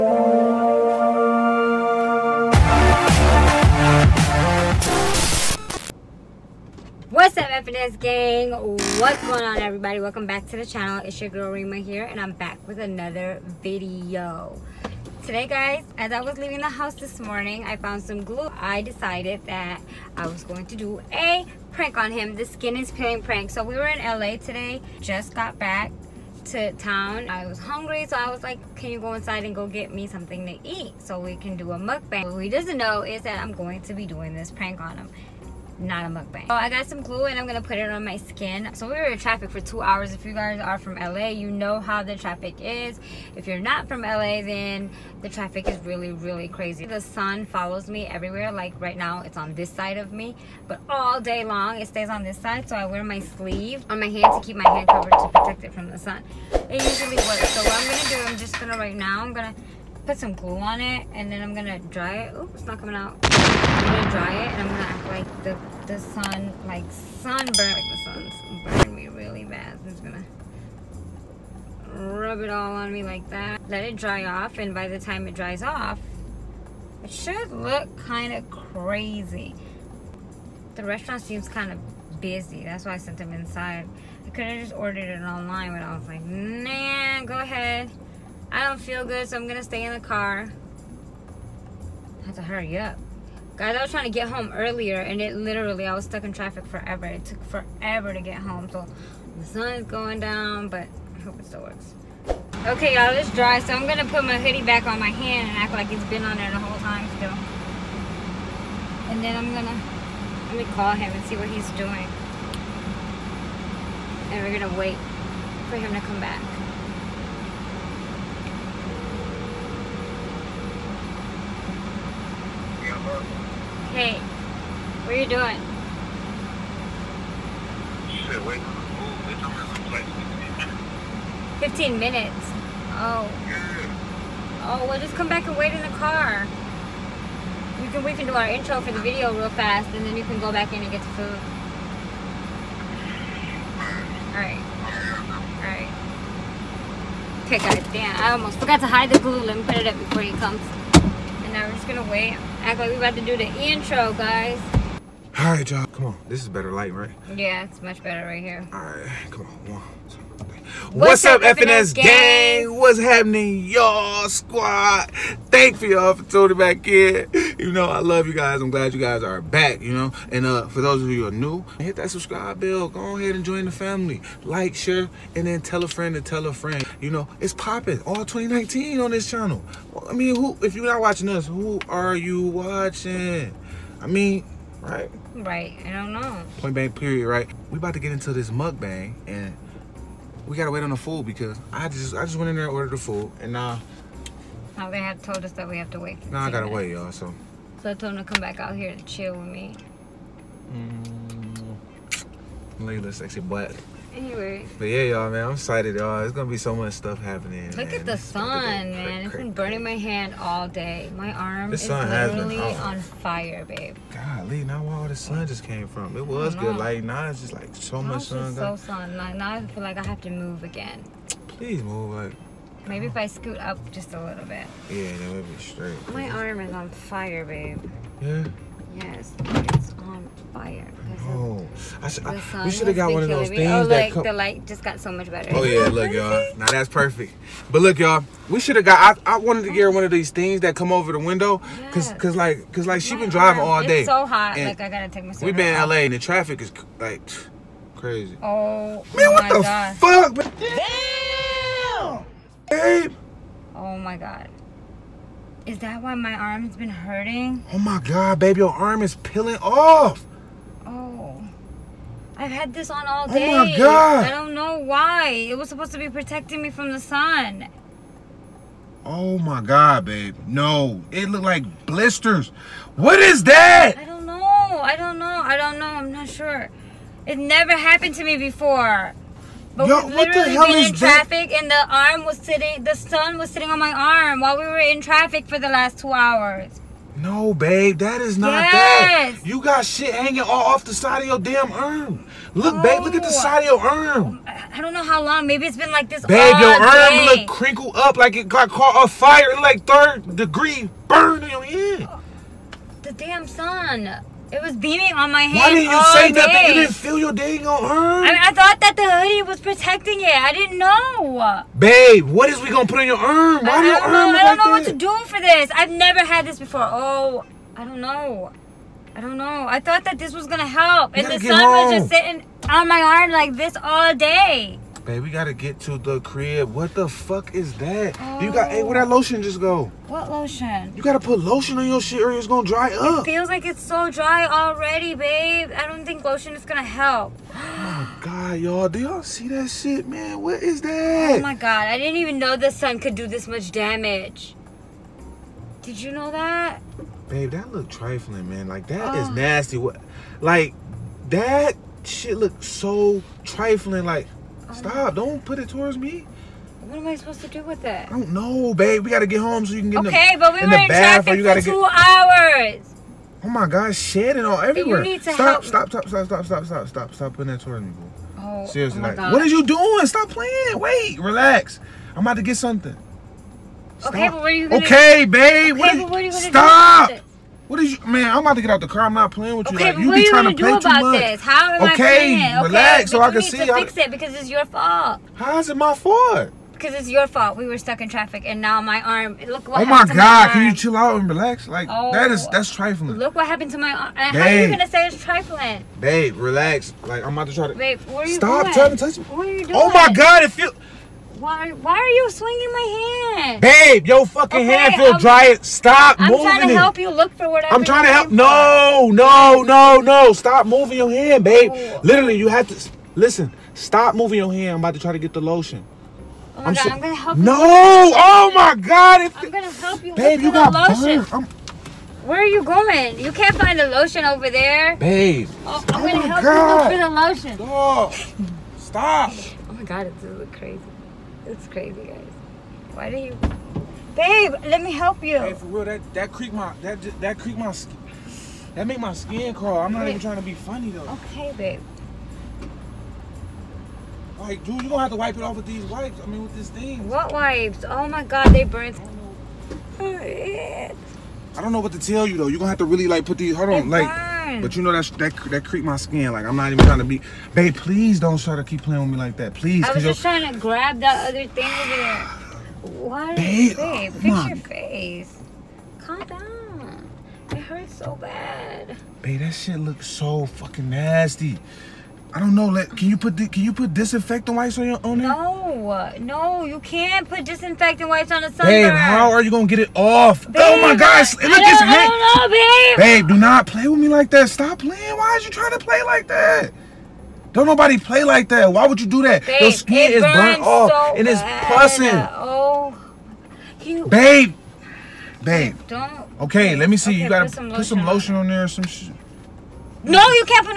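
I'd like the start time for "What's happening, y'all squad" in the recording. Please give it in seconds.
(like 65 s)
162 s.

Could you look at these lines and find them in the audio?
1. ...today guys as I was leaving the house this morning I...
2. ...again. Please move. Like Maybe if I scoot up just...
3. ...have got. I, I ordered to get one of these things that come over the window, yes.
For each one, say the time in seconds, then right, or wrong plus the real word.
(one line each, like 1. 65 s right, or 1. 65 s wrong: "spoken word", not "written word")
1. 15 s right
2. 220 s right
3. 238 s wrong: "wanted", not "ordered".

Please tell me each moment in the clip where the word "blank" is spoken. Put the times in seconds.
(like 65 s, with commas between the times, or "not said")
186 s.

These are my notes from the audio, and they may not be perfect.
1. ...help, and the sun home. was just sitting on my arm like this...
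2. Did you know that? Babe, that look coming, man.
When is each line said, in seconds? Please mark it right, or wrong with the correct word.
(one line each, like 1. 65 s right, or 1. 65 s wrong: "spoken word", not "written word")
1. 320 s right
2. 345 s wrong: "trifling", not "coming".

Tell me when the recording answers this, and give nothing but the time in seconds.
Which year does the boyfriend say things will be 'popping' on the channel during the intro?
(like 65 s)
178 s.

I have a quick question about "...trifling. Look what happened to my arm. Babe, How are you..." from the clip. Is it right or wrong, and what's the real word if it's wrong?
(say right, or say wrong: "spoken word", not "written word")
right.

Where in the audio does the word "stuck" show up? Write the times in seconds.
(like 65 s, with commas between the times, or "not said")
96 s, 387 s.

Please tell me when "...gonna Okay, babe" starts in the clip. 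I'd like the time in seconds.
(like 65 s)
374 s.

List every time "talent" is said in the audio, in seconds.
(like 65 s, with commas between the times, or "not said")
not said.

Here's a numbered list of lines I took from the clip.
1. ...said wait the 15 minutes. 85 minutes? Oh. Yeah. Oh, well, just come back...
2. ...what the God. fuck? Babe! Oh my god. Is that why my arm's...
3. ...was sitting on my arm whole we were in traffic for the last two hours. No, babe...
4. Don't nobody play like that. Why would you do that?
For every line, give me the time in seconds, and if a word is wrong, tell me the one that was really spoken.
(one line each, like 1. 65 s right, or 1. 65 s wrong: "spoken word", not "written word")
1. 128 s wrong: "15", not "85"
2. 249 s right
3. 283 s wrong: "while", not "whole"
4. 487 s right.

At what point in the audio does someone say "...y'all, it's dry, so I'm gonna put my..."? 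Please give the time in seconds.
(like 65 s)
102 s.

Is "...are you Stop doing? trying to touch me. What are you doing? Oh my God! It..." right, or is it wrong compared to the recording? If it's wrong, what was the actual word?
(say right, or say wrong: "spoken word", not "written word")
right.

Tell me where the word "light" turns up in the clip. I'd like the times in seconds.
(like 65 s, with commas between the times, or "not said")
156 s, 234 s.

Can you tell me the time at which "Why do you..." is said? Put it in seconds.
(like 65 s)
432 s.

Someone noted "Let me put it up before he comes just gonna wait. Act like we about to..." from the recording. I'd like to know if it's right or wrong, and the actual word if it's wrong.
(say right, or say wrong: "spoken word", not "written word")
right.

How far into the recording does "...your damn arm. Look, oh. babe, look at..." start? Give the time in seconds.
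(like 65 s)
291 s.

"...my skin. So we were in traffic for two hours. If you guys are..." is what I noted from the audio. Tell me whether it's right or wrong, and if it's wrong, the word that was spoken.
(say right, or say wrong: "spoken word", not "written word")
right.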